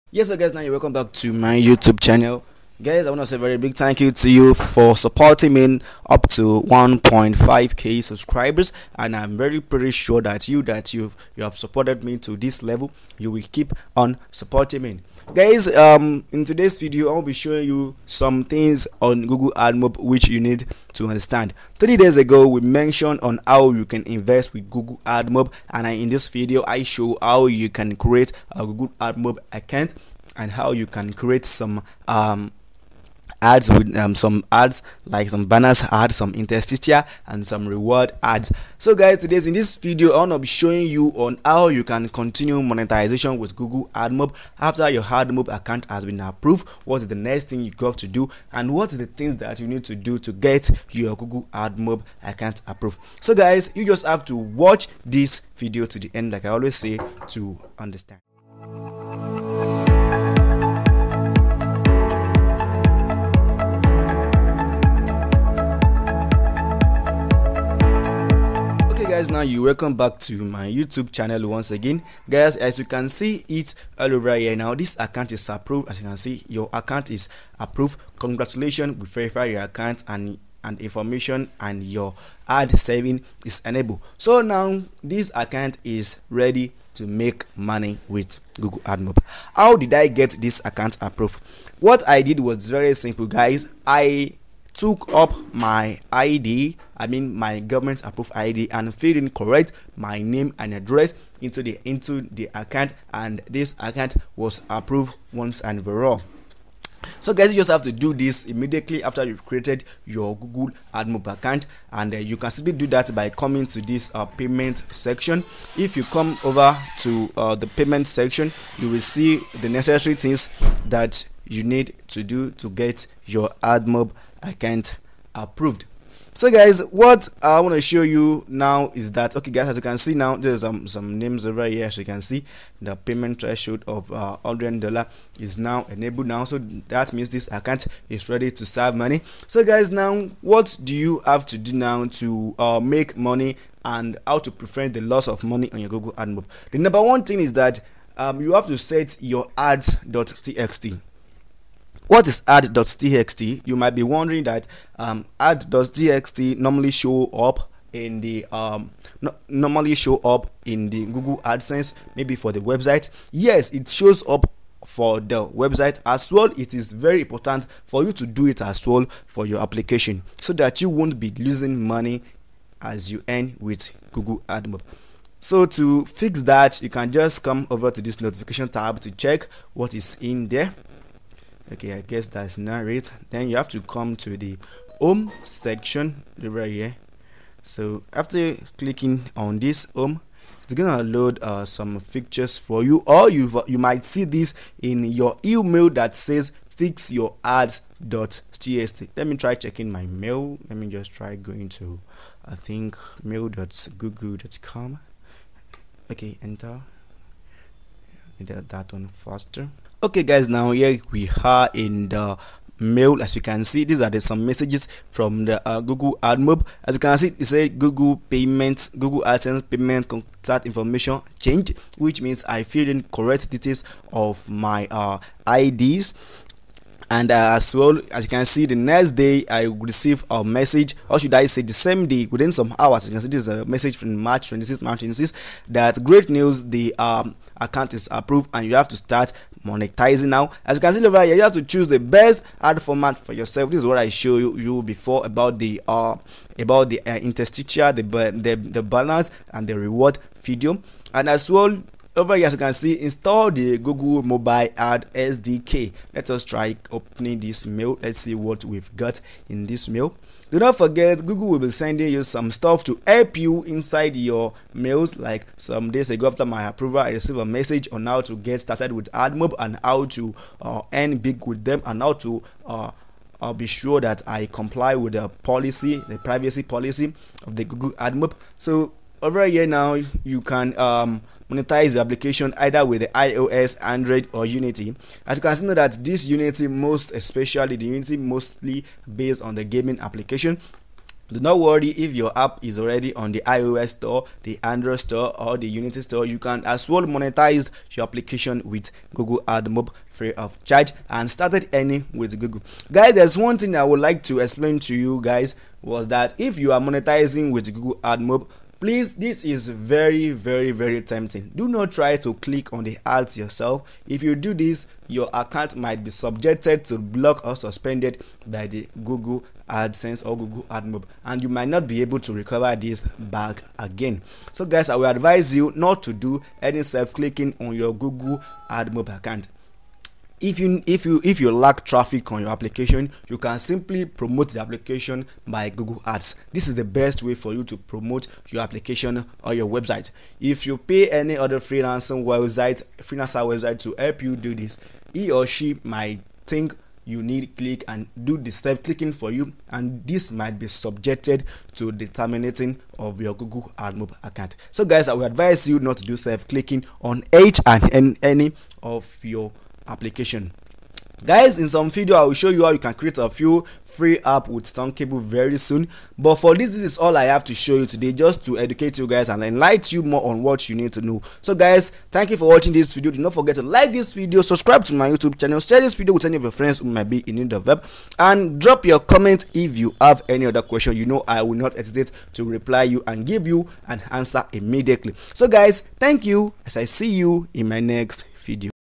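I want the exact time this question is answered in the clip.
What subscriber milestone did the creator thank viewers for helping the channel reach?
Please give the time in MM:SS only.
00:06.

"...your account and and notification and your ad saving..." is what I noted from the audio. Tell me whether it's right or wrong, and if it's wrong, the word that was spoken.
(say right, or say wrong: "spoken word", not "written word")
wrong: "information", not "notification".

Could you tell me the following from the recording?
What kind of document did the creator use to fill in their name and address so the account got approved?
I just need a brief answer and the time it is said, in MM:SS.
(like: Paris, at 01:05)
government approved ID, at 01:37.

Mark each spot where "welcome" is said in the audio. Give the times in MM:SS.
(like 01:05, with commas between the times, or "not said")
00:00, 01:09.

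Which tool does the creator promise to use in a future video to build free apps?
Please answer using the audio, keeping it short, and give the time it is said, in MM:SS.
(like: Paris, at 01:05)
Thunkable, at 06:04.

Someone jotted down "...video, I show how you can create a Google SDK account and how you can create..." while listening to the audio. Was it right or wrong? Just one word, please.
wrong.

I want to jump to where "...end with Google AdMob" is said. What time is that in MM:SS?
02:53.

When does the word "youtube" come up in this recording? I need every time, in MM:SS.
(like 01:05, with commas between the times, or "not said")
00:01, 01:10, 06:15.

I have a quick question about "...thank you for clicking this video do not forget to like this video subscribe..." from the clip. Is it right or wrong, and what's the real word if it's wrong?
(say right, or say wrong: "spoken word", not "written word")
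wrong: "watching", not "clicking".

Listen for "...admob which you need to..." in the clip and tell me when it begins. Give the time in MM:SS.
00:19.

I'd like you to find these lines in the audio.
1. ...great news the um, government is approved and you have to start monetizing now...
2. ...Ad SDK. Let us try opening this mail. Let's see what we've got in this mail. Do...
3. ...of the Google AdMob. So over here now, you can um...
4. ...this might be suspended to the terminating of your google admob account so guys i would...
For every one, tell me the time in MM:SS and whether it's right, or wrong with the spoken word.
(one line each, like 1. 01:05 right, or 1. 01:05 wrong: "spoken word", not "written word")
1. 03:56 wrong: "account", not "government"
2. 04:14 right
3. 04:37 right
4. 05:50 wrong: "subjected", not "suspended".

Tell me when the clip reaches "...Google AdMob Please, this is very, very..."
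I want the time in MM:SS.
05:07.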